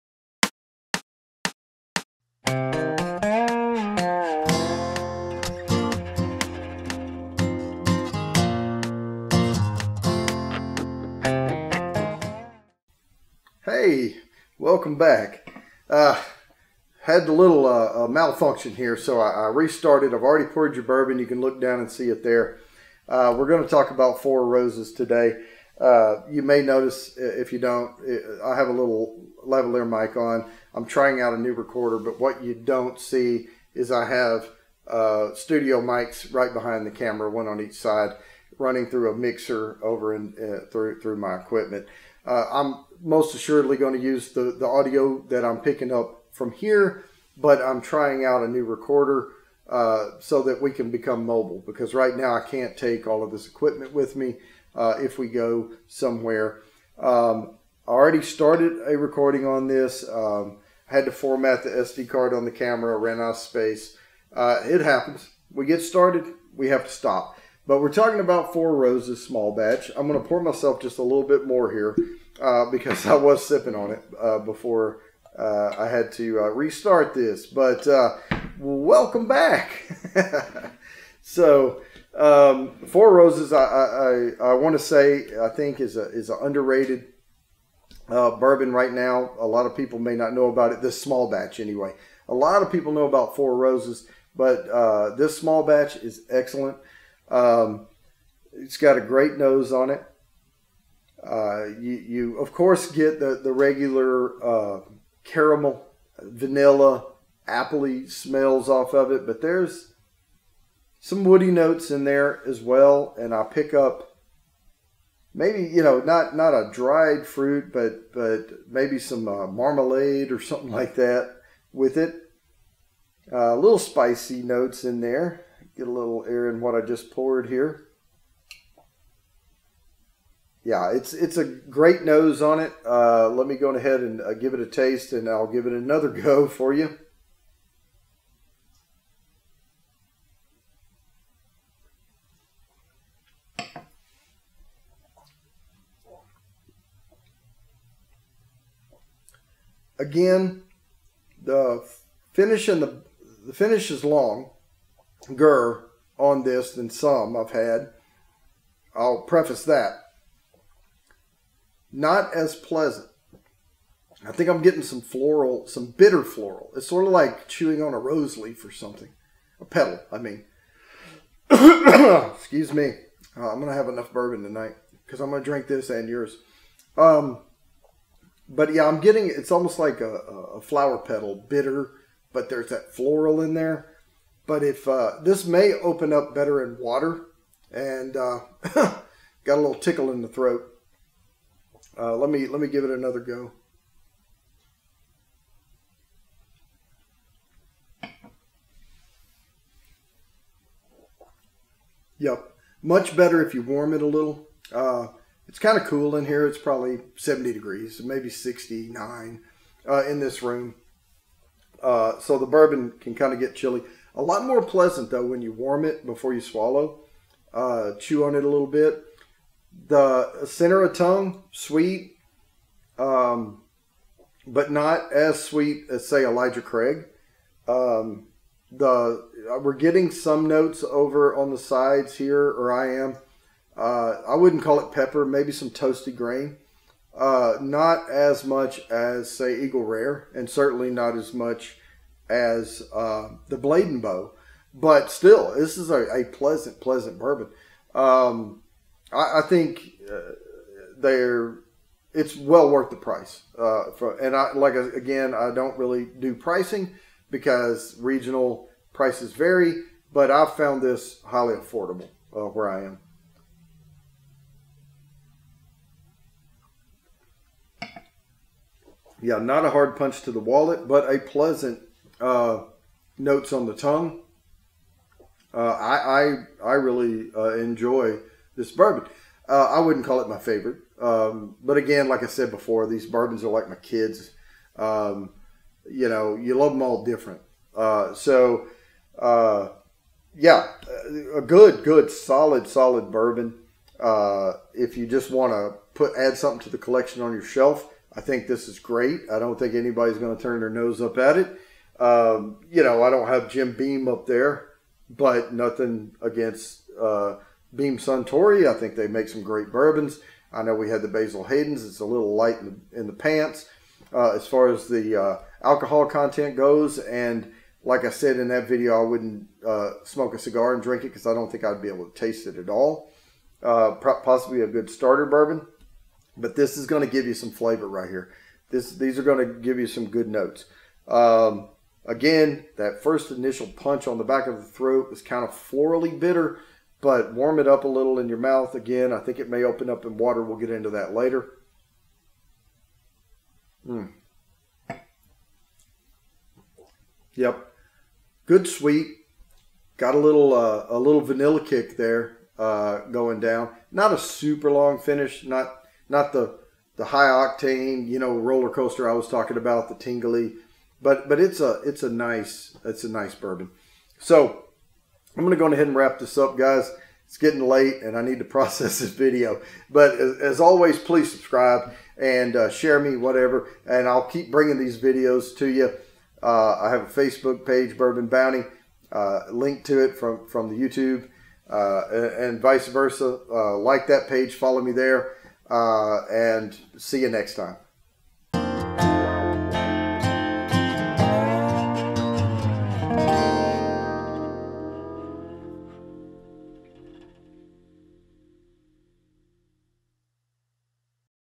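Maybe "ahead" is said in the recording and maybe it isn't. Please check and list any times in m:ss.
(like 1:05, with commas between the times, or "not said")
2:13, 6:05.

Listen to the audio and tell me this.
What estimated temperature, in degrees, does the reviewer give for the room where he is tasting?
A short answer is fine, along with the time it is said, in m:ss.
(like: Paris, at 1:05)
70, at 3:27.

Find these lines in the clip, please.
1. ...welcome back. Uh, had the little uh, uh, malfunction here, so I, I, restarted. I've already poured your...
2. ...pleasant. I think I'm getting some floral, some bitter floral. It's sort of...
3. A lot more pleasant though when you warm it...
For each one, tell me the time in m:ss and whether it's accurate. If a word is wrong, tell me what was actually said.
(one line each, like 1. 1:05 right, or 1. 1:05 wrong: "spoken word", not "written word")
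1. 0:14 right
2. 2:42 right
3. 3:34 right.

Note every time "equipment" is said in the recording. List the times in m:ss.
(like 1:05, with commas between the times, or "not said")
0:41, 0:53.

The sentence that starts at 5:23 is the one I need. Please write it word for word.
Uh, possibly a good starter bourbon.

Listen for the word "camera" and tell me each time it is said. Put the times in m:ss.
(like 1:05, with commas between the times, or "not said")
0:36, 1:02.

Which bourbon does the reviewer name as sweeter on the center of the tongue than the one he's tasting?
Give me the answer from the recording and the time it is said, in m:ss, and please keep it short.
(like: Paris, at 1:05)
Elijah Craig, at 3:46.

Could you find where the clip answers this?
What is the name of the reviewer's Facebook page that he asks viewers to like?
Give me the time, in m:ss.
6:17.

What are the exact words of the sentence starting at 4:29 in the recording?
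Yeah, not a hard punch to the wallet, but a pleasant uh, notes on the tongue.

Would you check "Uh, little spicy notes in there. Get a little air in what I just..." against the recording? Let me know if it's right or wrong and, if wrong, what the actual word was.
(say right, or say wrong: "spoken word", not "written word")
right.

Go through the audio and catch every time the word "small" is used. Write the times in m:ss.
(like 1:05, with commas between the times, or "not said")
1:09, 1:31, 1:35.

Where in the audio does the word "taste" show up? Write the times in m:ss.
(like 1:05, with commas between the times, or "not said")
2:14, 5:22.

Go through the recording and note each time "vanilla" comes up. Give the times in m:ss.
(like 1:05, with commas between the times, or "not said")
1:46, 5:51.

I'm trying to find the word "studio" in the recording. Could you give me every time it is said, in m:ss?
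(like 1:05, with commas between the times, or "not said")
0:35.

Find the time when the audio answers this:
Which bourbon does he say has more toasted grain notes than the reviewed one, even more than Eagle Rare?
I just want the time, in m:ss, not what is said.
4:03.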